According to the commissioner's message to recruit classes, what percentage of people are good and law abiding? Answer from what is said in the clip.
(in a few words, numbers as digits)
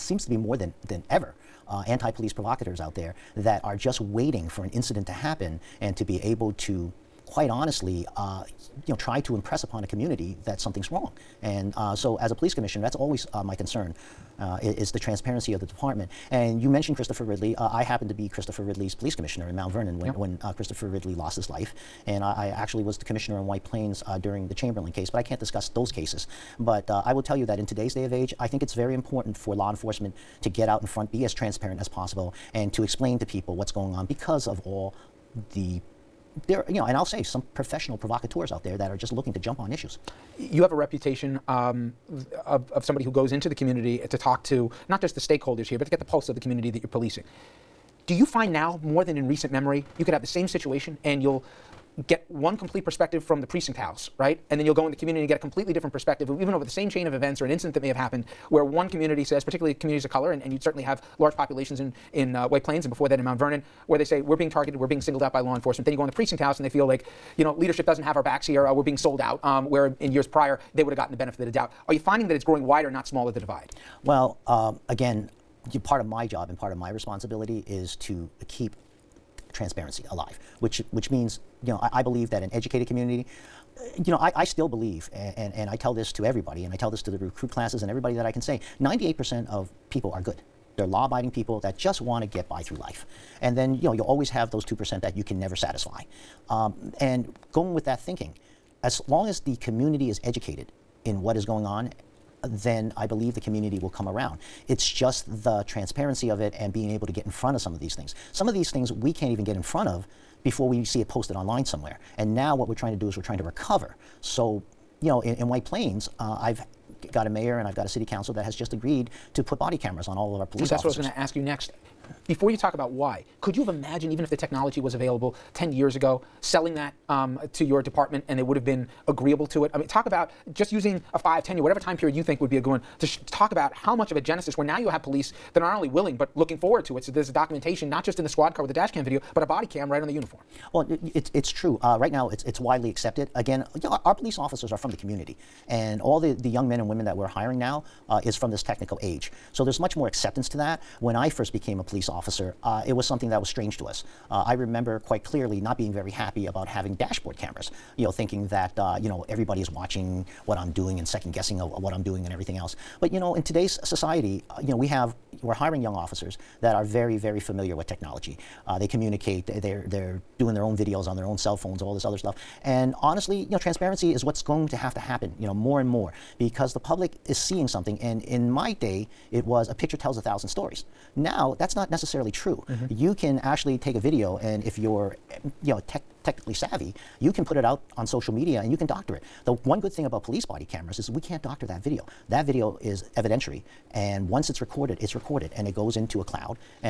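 98%.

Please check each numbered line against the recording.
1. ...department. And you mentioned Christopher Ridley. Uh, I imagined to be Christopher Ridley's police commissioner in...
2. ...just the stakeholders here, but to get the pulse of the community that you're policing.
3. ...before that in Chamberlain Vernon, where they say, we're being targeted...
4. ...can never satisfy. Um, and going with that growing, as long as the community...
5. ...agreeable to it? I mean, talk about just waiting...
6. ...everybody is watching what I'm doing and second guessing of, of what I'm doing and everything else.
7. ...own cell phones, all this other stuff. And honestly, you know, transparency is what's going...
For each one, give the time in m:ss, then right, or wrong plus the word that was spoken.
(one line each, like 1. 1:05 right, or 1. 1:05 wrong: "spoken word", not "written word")
1. 0:15 wrong: "happened", not "imagined"
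2. 0:45 right
3. 1:02 wrong: "Mount", not "Chamberlain"
4. 1:35 wrong: "thinking", not "growing"
5. 2:09 wrong: "using", not "waiting"
6. 2:39 right
7. 2:51 right.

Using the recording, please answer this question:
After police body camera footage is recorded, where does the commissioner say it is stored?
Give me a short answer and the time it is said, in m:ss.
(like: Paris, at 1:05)
a cloud, at 3:16.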